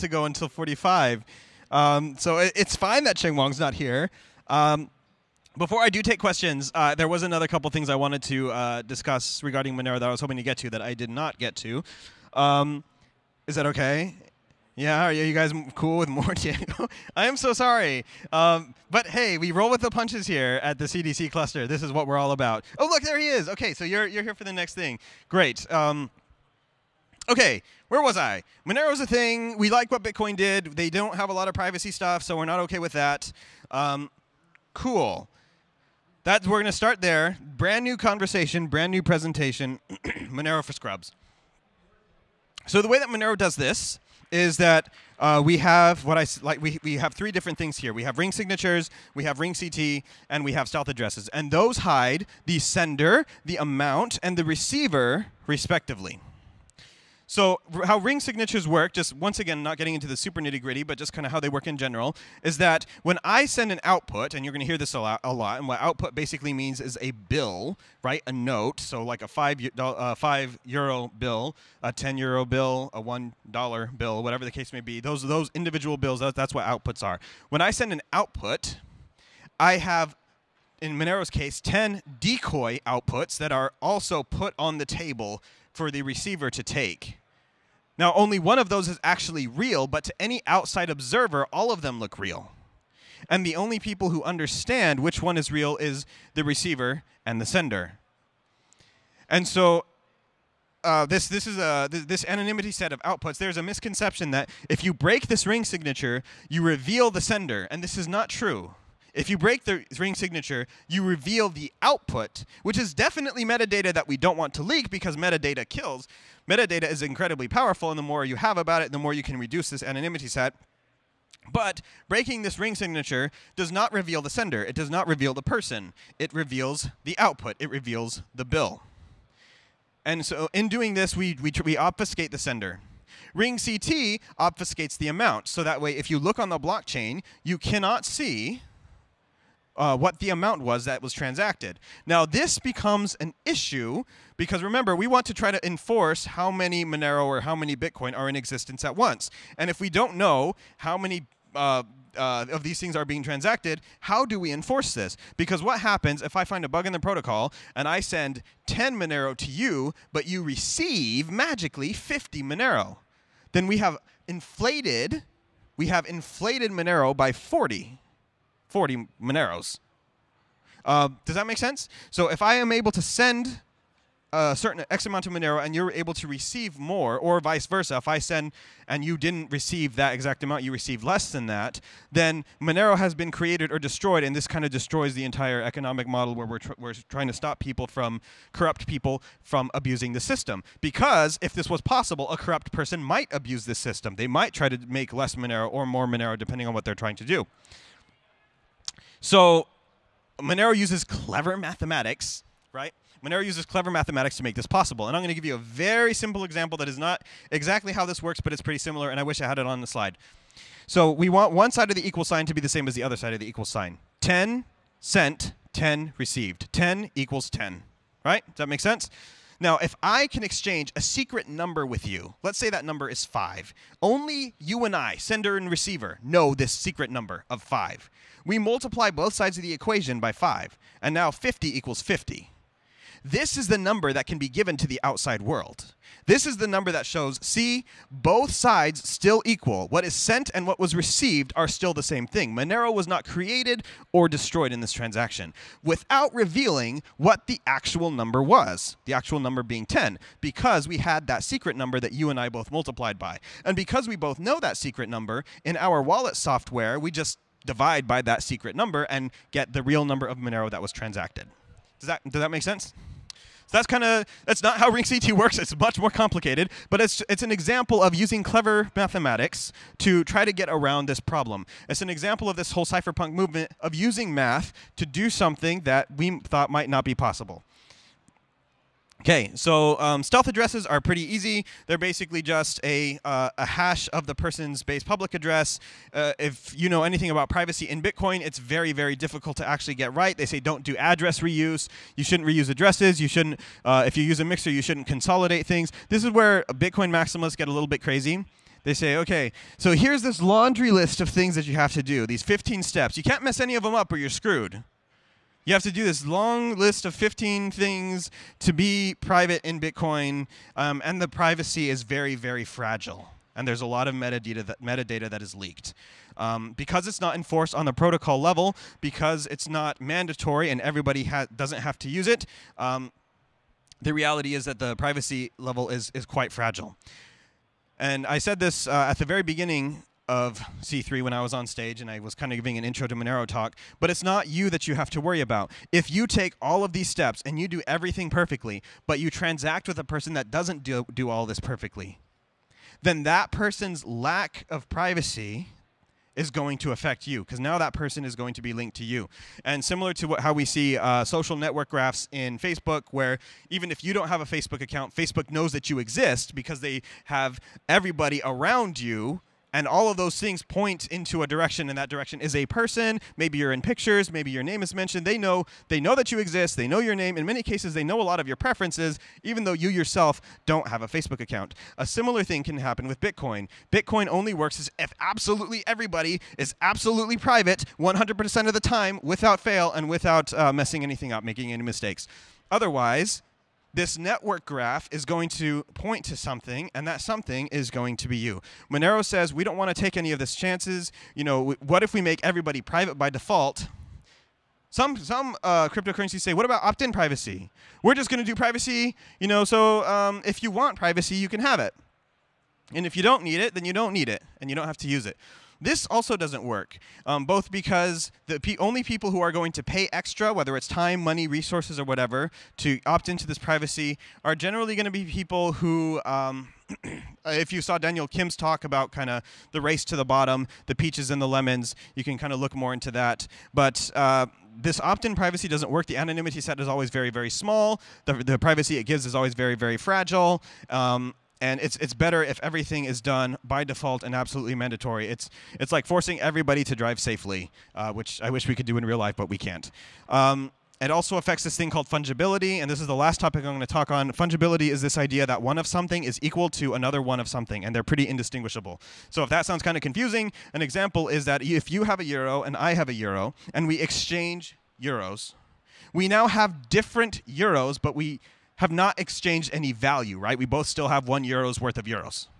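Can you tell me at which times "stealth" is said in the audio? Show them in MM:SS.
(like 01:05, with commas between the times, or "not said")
00:50, 04:40.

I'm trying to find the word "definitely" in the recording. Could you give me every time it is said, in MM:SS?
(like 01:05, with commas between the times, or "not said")
01:52.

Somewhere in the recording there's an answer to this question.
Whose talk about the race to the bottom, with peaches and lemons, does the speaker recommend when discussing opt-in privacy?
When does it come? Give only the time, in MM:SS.
06:57.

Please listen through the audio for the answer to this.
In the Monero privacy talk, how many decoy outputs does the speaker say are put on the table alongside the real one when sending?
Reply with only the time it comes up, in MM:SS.
01:21.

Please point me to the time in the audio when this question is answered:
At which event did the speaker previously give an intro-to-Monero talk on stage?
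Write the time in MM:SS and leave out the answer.
05:30.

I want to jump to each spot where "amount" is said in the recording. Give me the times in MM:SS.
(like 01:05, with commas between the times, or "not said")
00:53, 02:15, 02:20, 02:55, 03:00.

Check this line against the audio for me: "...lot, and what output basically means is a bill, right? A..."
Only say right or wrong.
right.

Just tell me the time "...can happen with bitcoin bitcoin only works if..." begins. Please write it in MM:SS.
06:12.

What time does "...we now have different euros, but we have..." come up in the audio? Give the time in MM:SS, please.
07:36.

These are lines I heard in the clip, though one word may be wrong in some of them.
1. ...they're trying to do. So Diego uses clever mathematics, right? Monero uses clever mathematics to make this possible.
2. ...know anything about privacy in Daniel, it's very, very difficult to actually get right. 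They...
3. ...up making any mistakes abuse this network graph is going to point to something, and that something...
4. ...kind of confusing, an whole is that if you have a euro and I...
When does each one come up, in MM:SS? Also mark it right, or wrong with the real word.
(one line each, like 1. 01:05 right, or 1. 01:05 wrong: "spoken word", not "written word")
1. 03:16 wrong: "Monero", not "Diego"
2. 04:46 wrong: "Bitcoin", not "Daniel"
3. 06:21 wrong: "otherwise", not "abuse"
4. 07:29 wrong: "example", not "whole".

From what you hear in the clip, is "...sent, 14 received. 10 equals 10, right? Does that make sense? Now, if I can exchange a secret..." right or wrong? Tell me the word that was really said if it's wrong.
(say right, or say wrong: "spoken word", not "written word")
wrong: "10", not "14".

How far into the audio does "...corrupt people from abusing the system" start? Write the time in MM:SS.
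03:08.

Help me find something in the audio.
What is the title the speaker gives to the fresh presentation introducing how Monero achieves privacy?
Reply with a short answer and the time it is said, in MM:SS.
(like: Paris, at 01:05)
Monero for Scrubs, at 00:40.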